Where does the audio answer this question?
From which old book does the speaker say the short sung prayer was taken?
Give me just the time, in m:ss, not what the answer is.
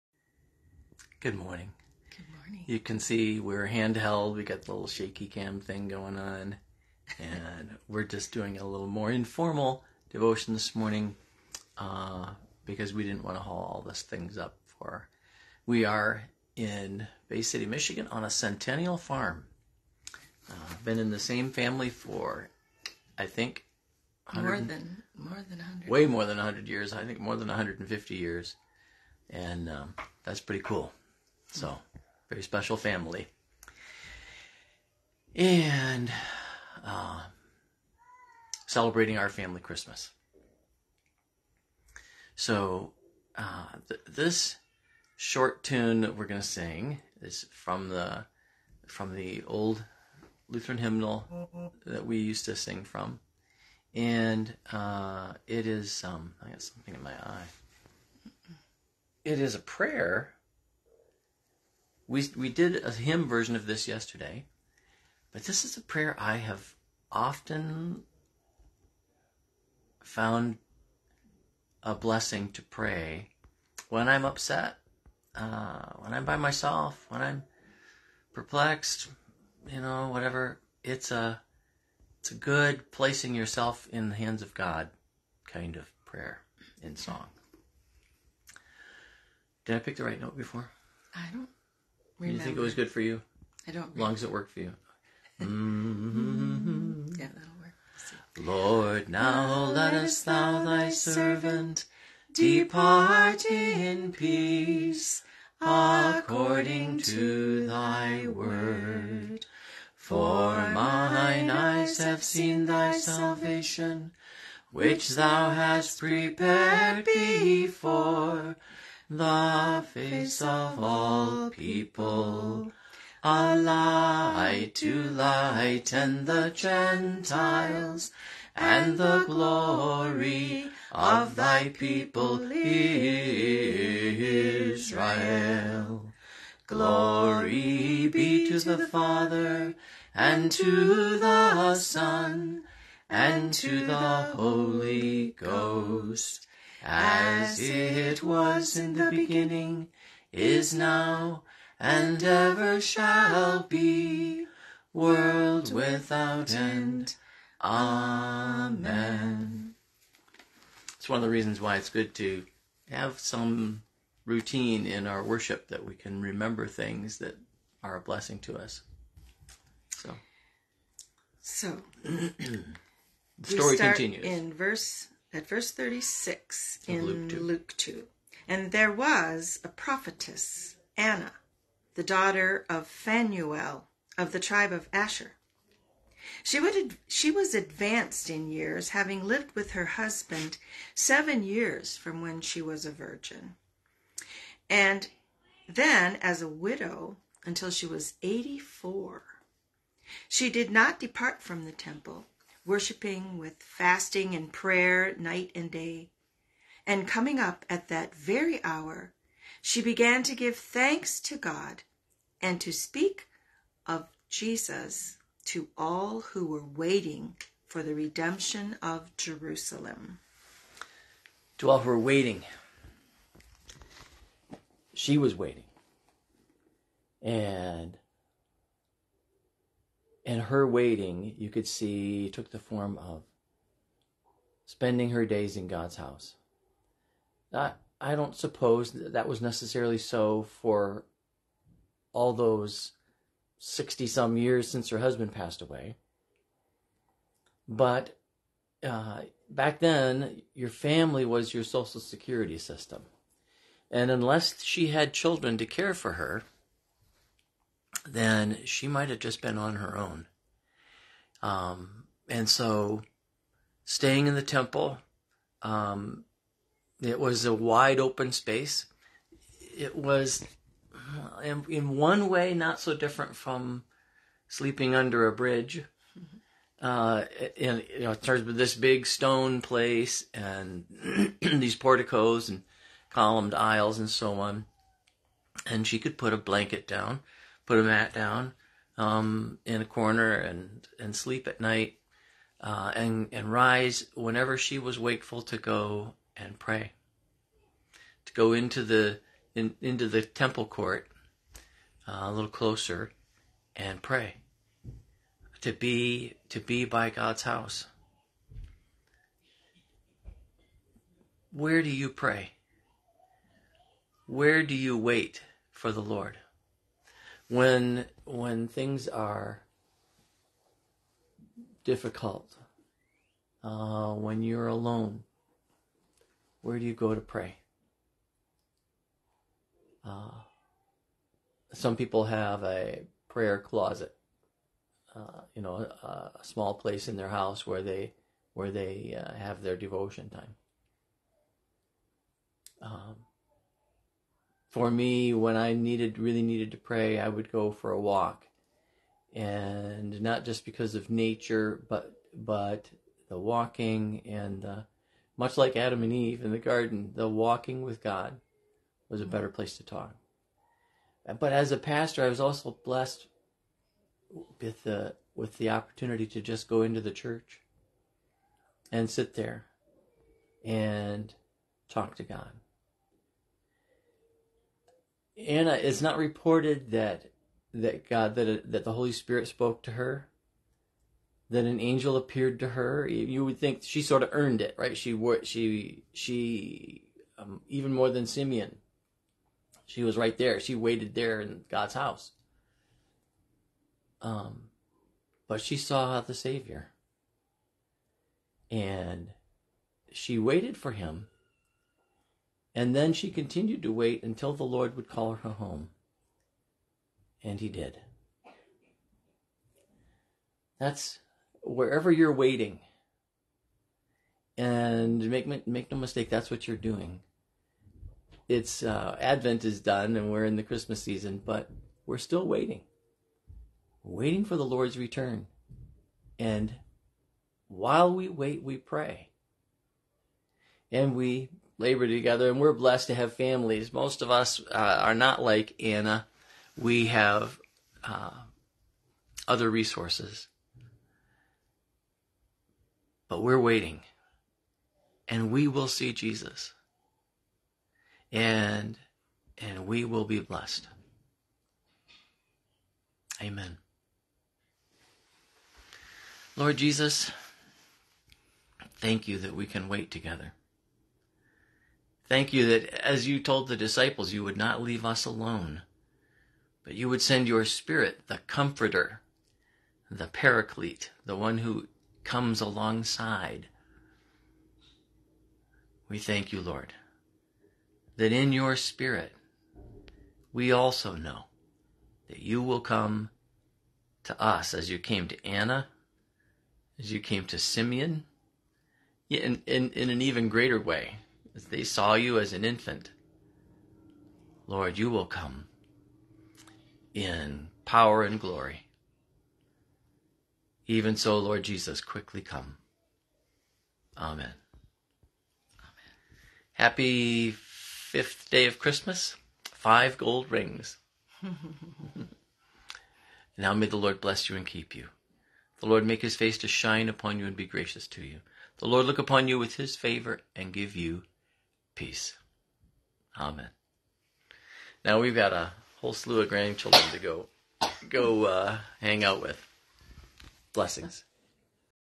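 0:50.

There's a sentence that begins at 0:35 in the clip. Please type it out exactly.
And uh, celebrating our family Christmas.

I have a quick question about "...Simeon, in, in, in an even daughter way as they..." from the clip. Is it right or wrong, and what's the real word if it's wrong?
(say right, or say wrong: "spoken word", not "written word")
wrong: "greater", not "daughter".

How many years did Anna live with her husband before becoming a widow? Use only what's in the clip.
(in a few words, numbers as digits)
7.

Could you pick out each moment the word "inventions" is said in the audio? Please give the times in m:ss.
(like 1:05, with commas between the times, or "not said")
not said.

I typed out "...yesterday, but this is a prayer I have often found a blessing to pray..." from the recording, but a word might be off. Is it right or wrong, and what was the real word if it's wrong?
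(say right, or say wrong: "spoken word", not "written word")
right.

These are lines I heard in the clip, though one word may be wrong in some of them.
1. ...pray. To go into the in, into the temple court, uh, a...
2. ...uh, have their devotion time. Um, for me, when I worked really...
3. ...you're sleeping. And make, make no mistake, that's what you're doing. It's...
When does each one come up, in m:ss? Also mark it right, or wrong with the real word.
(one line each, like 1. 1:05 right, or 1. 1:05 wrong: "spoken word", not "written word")
1. 4:56 right
2. 5:39 wrong: "needed", not "worked"
3. 6:52 wrong: "waiting", not "sleeping".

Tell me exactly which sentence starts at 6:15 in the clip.
Anna, it's not reported that that God that that the Holy Spirit spoke to her, that an angel appeared to her.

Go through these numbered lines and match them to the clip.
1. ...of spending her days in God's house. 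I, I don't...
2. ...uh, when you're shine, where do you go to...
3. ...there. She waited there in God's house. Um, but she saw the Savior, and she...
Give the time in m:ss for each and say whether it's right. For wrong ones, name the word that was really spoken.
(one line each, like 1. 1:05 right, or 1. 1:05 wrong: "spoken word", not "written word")
1. 3:52 right
2. 5:23 wrong: "alone", not "shine"
3. 6:30 right.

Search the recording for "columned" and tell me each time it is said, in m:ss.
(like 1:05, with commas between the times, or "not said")
4:43.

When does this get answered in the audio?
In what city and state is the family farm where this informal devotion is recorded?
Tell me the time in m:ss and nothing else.
0:17.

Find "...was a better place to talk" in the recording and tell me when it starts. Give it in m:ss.
5:59.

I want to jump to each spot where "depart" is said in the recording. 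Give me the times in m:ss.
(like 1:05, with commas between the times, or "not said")
1:42, 3:20.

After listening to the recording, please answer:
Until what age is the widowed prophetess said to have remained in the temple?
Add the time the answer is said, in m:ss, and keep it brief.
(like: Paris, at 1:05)
84, at 3:18.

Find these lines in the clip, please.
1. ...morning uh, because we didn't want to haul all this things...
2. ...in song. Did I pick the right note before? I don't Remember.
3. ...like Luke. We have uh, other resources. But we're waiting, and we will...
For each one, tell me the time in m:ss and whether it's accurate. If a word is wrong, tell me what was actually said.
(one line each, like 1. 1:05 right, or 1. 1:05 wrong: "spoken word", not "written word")
1. 0:10 right
2. 1:26 right
3. 7:15 wrong: "Anna", not "Luke".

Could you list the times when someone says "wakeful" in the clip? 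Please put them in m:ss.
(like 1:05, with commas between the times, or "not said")
4:54.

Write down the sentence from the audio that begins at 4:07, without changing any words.
But uh, back then, your family was your social security system.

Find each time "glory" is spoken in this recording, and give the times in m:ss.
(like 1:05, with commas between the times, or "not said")
2:09, 2:16, 8:18.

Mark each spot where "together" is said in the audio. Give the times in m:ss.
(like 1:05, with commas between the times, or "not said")
7:12, 7:40.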